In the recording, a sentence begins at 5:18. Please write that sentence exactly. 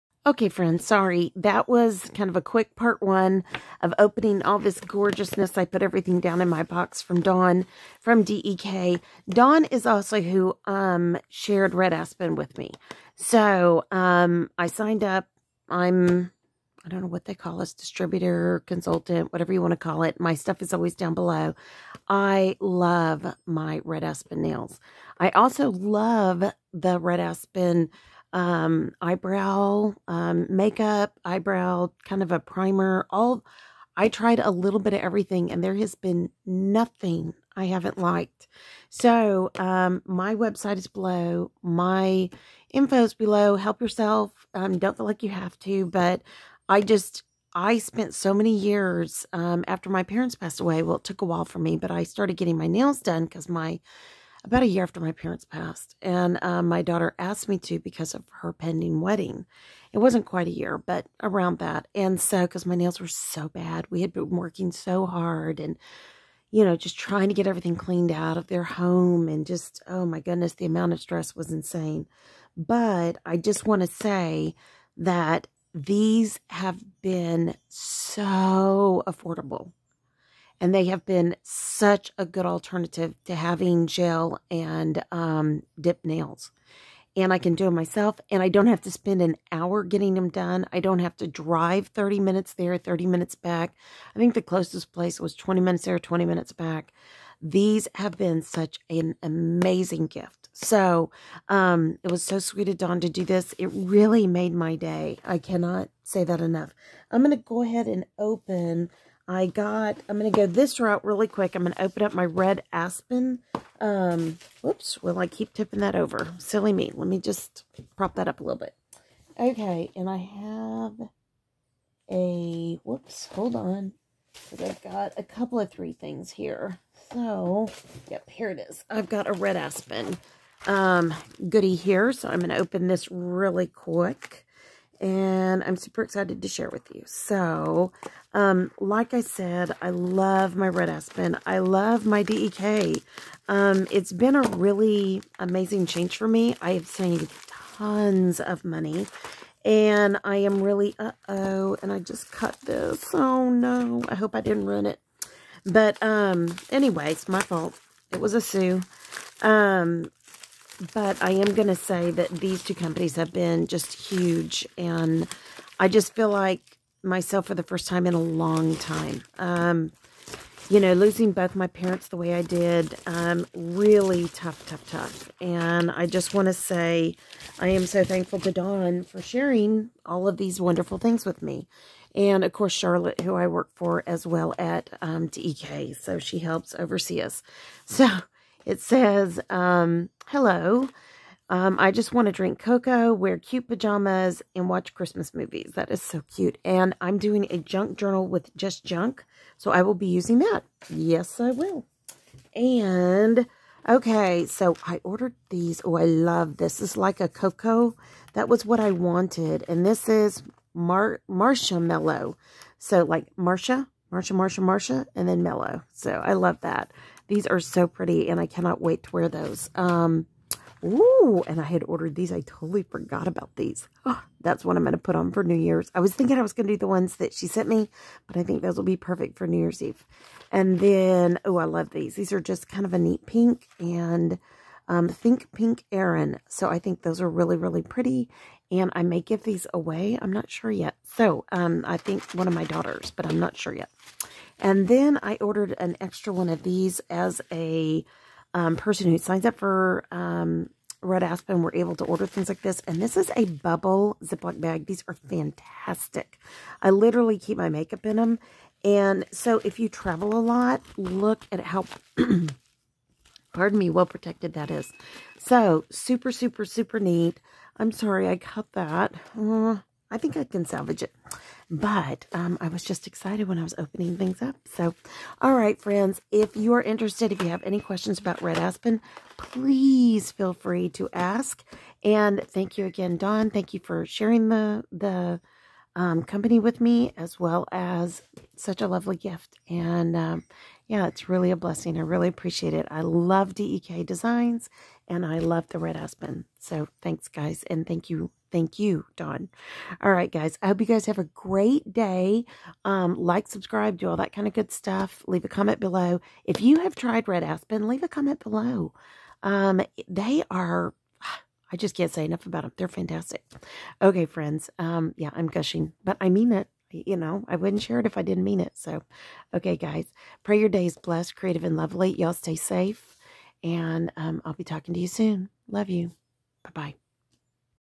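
So, okay, guys, pray your day is blessed, creative, and lovely.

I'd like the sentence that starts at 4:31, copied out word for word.
But um, I was just excited when I was opening things up.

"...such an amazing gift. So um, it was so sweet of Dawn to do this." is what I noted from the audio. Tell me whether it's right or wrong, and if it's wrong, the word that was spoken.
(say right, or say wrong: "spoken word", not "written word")
right.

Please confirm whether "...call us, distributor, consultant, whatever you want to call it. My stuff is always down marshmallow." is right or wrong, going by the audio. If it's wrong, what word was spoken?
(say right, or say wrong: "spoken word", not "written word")
wrong: "below", not "marshmallow".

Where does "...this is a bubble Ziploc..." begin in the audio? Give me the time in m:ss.
4:13.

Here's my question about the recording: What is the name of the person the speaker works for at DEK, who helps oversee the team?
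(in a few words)
Charlotte.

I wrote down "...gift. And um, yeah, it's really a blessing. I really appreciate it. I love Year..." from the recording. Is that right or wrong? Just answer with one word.
wrong.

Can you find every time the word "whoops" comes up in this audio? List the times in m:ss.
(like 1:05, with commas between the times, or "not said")
1:54, 2:02.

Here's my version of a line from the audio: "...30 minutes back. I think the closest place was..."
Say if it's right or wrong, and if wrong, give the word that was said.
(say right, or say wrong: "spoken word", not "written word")
right.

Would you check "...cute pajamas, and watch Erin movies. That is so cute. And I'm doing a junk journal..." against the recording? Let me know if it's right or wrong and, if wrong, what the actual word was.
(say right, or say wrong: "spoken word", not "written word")
wrong: "Christmas", not "Erin".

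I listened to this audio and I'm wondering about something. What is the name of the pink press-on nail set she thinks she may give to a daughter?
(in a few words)
Think Pink Erin.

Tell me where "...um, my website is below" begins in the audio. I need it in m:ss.
0:39.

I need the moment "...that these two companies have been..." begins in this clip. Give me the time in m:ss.
2:42.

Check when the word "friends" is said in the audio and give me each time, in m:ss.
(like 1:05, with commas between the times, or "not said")
0:00, 4:35, 5:14.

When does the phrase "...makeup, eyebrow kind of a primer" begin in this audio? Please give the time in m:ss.
0:30.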